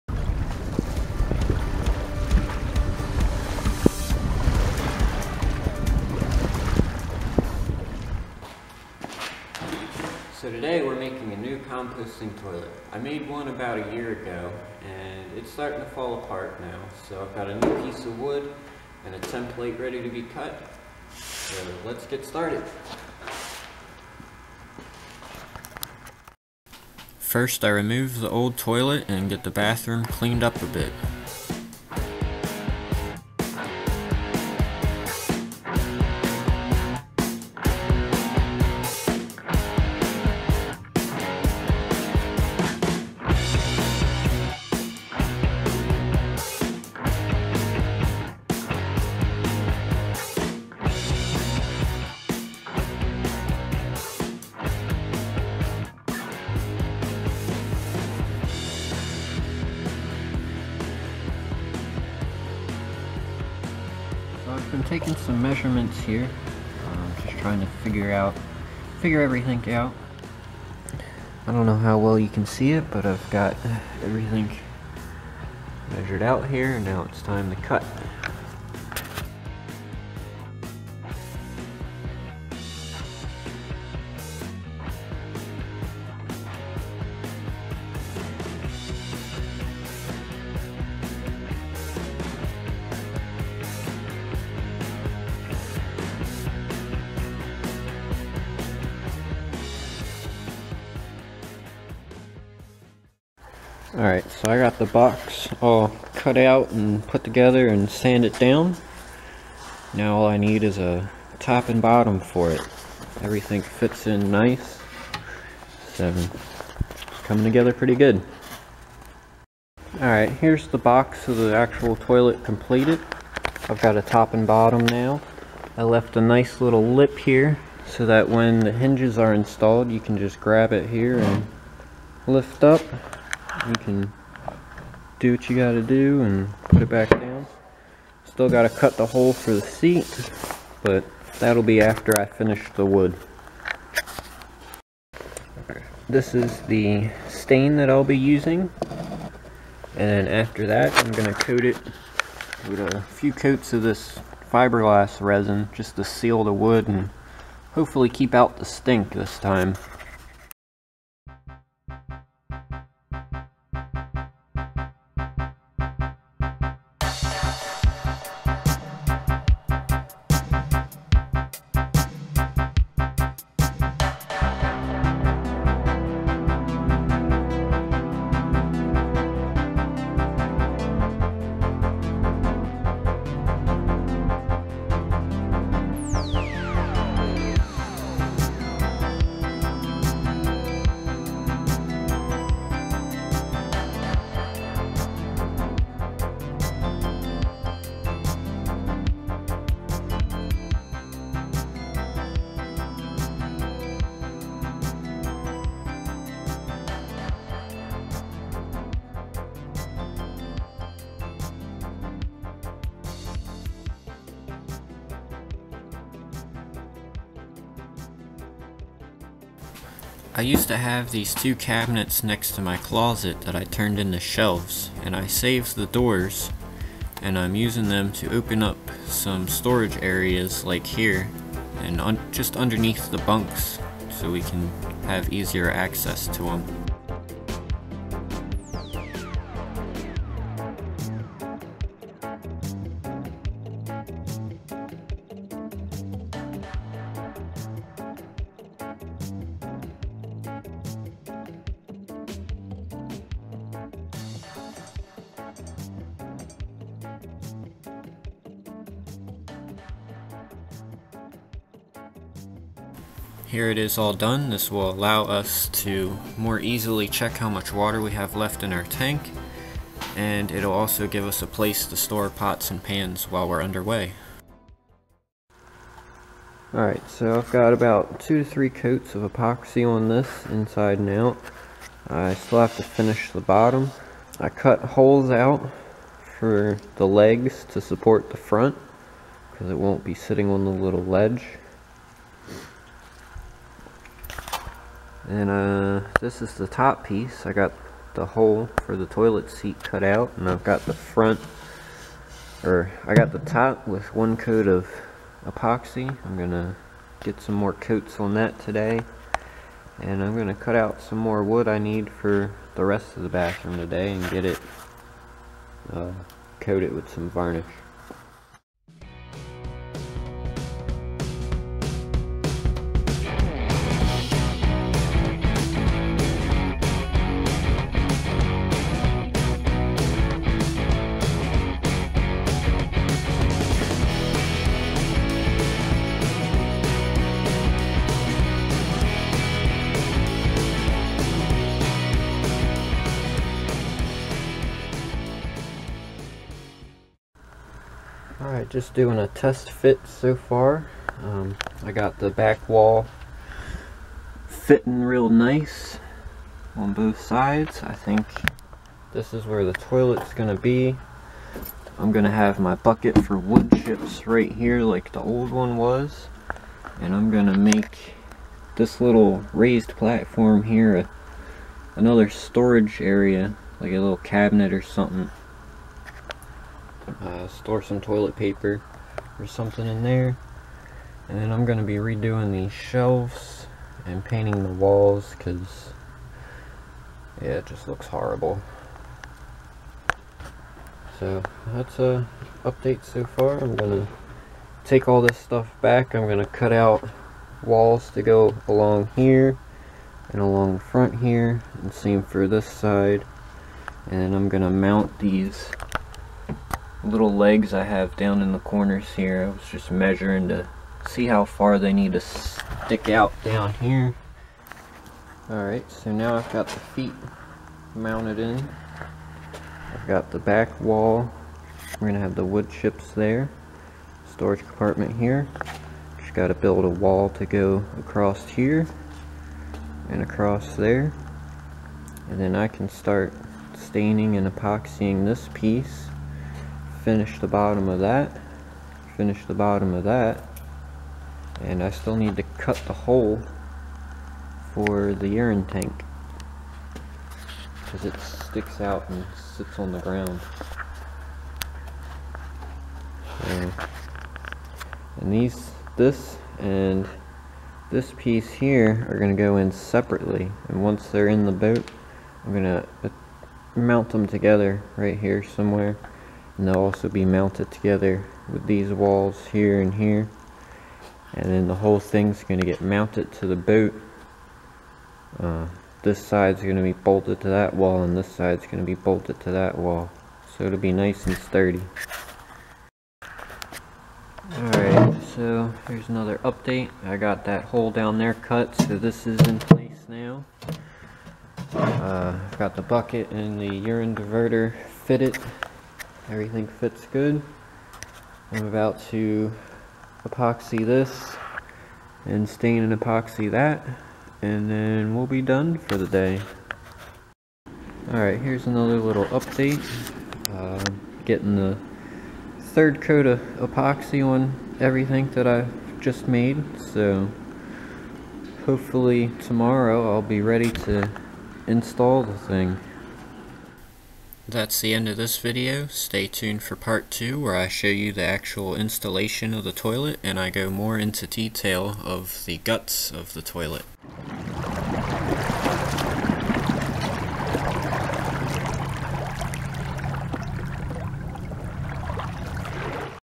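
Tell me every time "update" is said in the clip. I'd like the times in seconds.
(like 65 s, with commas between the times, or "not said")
392 s, 486 s, 509 s.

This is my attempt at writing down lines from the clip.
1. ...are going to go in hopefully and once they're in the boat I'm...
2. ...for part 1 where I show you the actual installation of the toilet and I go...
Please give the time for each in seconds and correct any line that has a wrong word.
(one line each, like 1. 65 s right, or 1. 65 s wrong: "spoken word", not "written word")
1. 459 s wrong: "separately", not "hopefully"
2. 526 s wrong: "2", not "1".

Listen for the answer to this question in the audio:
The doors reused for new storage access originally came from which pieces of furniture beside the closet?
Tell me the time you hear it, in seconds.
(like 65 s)
221 s.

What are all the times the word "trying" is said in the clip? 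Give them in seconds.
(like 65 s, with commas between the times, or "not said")
67 s.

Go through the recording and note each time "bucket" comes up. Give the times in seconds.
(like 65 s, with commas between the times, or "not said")
362 s, 492 s.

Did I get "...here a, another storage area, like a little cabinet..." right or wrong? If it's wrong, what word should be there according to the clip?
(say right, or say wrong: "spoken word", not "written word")
right.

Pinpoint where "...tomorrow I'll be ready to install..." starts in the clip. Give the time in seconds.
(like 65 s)
519 s.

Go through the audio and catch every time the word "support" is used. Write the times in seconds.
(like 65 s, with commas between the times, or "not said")
287 s.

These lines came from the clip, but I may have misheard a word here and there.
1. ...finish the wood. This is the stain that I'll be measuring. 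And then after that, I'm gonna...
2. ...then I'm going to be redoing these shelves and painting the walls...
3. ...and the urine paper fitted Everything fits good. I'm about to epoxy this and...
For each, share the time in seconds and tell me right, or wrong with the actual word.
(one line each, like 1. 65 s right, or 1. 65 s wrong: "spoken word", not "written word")
1. 142 s wrong: "using", not "measuring"
2. 381 s right
3. 493 s wrong: "diverter", not "paper".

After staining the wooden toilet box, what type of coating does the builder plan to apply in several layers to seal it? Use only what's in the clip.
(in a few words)
Fiberglass resin.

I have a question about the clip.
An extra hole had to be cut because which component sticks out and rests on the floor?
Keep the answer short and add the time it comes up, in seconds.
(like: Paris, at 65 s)
The urine tank, at 445 s.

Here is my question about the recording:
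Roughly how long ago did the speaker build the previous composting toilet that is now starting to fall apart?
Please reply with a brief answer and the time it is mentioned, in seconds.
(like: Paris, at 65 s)
About a year ago, at 13 s.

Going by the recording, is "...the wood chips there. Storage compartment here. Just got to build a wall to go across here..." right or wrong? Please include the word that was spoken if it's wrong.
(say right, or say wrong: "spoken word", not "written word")
right.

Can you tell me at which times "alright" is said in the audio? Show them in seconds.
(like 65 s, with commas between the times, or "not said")
103 s, 119 s, 276 s, 415 s, 484 s, 508 s.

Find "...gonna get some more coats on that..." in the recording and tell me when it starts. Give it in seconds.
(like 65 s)
306 s.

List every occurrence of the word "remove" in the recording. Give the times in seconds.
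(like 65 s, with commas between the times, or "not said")
27 s.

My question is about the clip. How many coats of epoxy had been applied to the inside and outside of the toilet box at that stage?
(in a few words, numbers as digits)
2 to 3.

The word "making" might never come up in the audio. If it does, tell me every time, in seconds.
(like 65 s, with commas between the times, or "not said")
10 s.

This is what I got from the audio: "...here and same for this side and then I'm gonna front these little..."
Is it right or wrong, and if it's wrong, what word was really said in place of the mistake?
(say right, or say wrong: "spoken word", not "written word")
wrong: "mount", not "front".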